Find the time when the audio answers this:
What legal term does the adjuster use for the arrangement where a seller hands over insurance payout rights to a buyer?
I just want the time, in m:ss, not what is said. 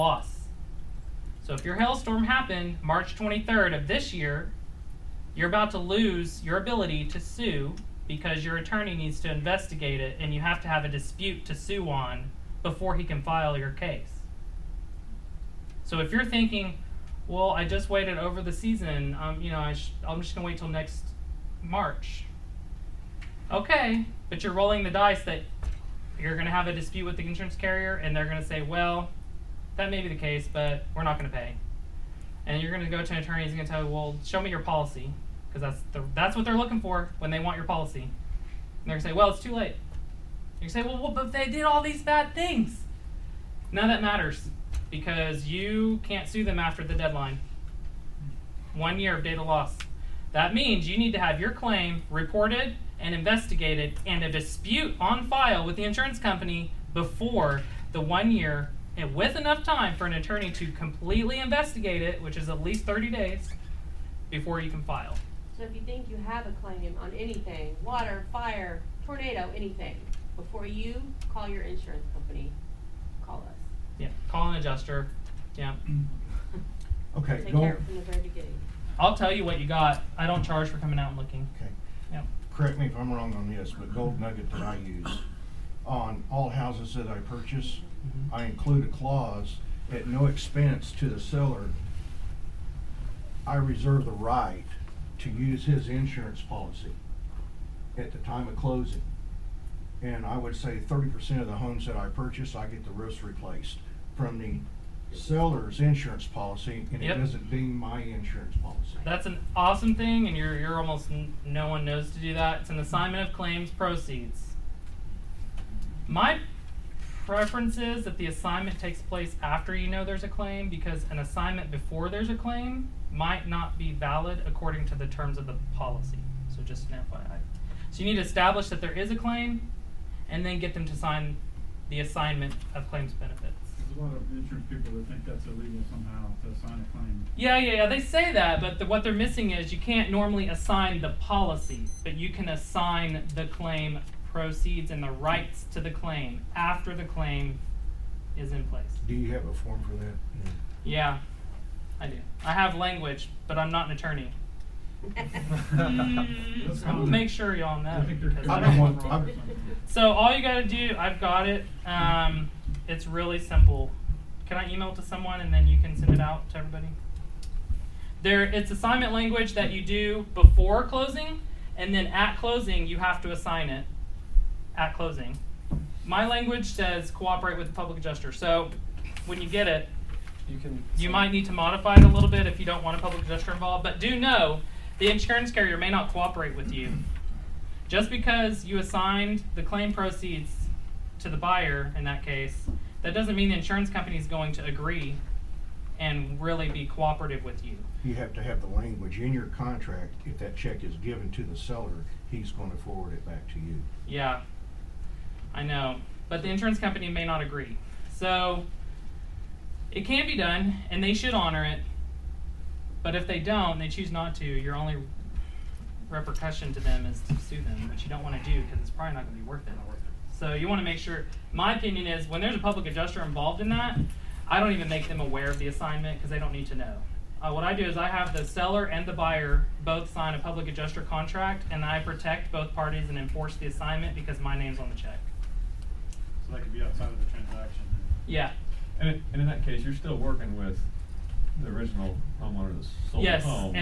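1:52.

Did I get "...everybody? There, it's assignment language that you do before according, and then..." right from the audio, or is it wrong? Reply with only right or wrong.
wrong.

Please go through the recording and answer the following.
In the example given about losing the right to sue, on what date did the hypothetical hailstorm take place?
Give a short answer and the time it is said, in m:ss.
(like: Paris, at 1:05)
March 23rd, at 0:02.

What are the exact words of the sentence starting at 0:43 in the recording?
None of that matters because you can't sue them after the deadline.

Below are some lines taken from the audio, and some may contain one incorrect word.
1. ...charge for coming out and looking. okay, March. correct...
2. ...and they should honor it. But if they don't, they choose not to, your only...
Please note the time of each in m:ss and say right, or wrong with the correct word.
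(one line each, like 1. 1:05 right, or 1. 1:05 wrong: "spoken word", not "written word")
1. 1:20 wrong: "Yeah", not "March"
2. 3:30 right.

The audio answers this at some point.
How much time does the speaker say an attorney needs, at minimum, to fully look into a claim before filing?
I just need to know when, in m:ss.
1:02.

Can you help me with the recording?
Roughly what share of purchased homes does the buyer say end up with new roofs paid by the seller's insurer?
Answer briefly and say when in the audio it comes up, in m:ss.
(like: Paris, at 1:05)
30 percent, at 1:40.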